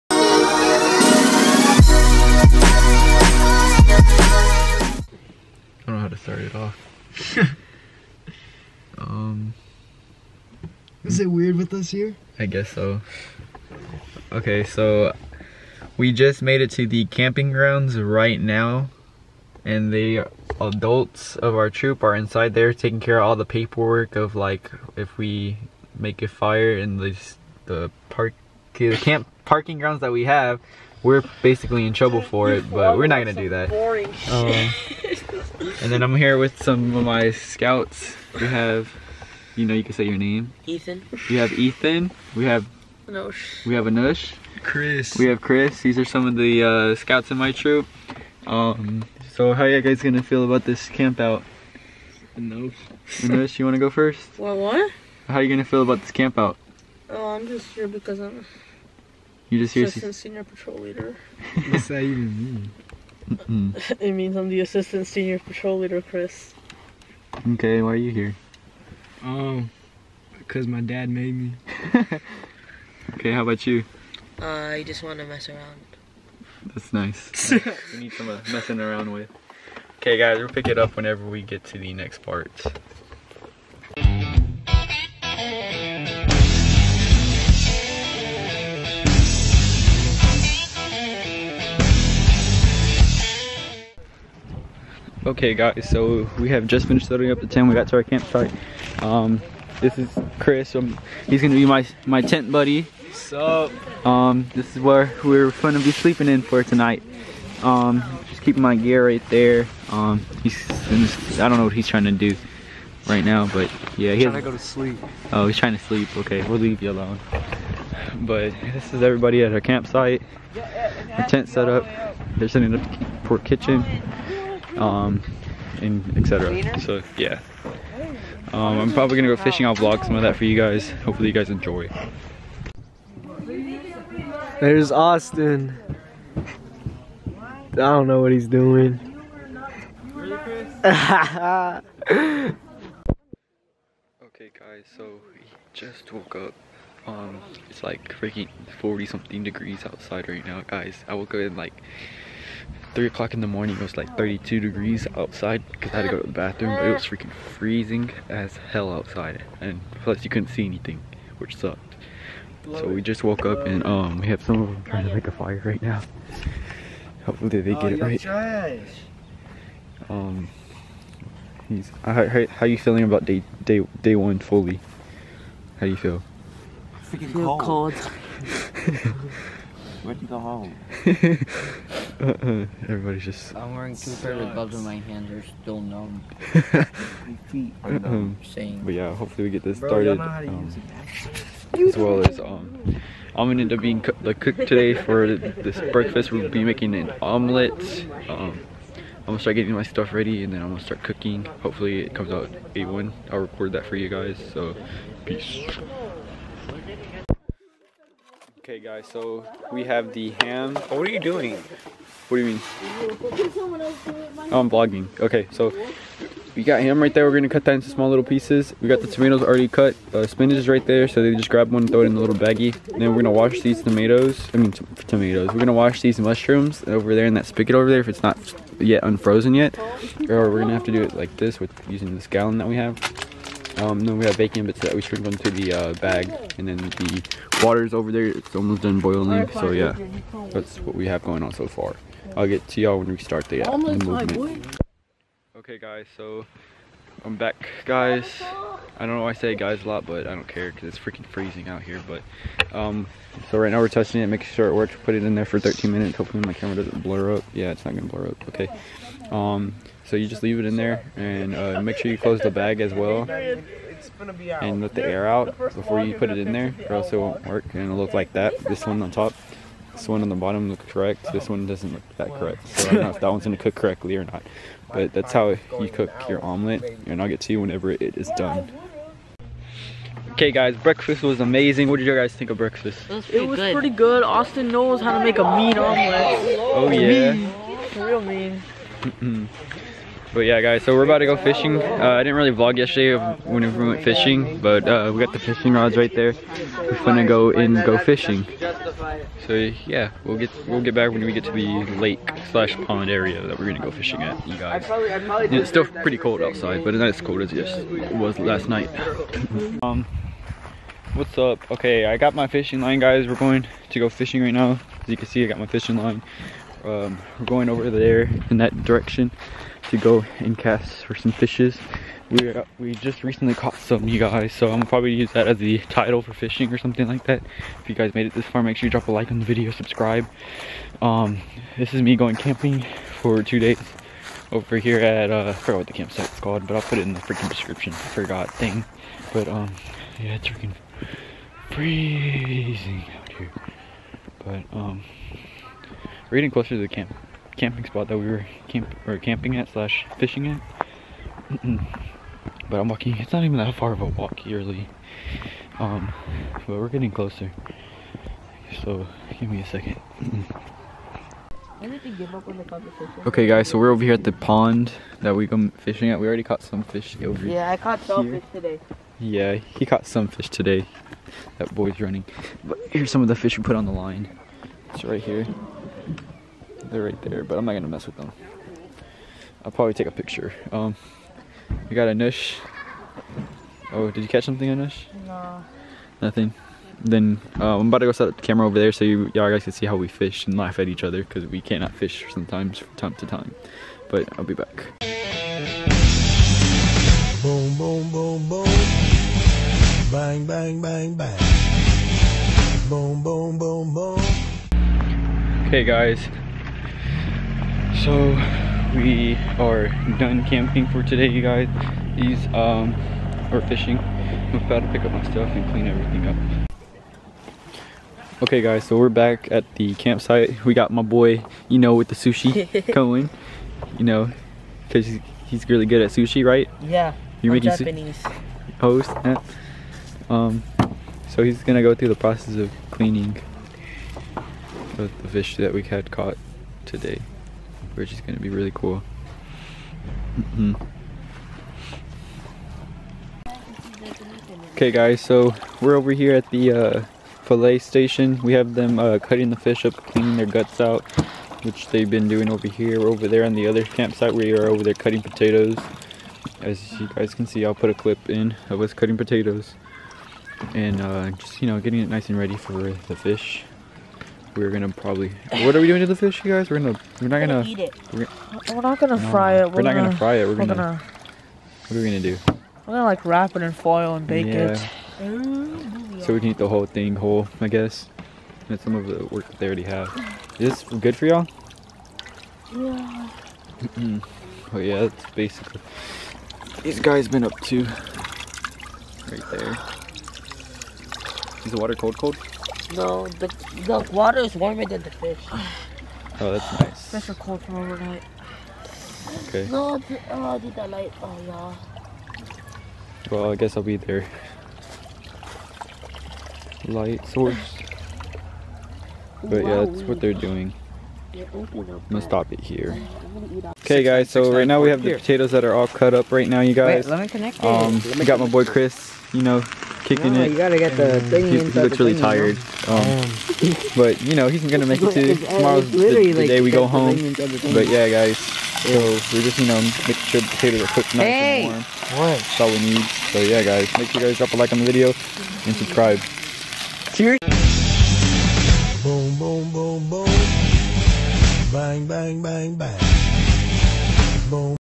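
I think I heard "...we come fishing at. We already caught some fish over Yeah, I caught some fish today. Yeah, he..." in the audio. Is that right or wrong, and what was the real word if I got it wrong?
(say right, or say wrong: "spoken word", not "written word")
right.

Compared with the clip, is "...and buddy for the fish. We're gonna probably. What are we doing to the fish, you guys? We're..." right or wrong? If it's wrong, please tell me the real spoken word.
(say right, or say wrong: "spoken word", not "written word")
wrong: "ready", not "buddy".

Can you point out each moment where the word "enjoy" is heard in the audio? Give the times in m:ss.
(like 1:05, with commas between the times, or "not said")
2:11.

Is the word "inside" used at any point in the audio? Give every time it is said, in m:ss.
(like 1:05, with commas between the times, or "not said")
0:22.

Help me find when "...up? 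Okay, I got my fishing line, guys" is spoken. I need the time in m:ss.
5:11.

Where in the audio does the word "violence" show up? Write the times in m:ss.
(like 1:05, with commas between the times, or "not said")
not said.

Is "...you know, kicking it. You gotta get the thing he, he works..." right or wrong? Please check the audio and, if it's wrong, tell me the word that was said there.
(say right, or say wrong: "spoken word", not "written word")
wrong: "looks", not "works".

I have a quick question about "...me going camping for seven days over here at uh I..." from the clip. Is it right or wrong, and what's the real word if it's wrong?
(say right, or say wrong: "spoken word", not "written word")
wrong: "two", not "seven".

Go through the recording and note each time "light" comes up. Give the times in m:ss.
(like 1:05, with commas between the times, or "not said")
8:20, 8:26.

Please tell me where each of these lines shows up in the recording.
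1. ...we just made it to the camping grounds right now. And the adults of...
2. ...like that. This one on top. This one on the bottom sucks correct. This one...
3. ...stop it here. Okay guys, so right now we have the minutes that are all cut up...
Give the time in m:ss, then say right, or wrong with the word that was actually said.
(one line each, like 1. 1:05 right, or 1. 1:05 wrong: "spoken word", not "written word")
1. 0:15 right
2. 4:28 wrong: "looks", not "sucks"
3. 8:32 wrong: "potatoes", not "minutes".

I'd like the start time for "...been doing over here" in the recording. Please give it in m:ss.
7:32.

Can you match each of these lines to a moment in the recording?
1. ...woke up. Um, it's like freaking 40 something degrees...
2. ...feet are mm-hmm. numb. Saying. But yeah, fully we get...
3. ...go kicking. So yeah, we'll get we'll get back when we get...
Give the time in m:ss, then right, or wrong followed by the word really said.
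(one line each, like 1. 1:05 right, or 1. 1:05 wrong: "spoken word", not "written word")
1. 2:26 right
2. 3:07 wrong: "hopefully", not "fully"
3. 4:57 wrong: "fishing", not "kicking".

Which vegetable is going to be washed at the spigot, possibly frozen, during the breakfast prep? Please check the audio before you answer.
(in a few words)
Mushrooms.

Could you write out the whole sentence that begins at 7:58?
And some of the work that they already have.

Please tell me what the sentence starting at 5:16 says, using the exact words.
Um, we're going over there in that direction to go and cast for some fishes.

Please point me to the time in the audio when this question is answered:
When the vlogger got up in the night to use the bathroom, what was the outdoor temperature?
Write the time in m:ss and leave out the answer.
2:34.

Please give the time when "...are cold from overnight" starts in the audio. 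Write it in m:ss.
8:17.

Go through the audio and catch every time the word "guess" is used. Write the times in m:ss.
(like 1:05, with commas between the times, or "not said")
0:12, 7:57, 8:23.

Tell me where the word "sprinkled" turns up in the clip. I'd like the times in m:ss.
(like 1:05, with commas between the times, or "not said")
3:55.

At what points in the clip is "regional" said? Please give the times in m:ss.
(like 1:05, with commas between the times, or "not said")
not said.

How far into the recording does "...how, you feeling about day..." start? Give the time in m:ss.
2:52.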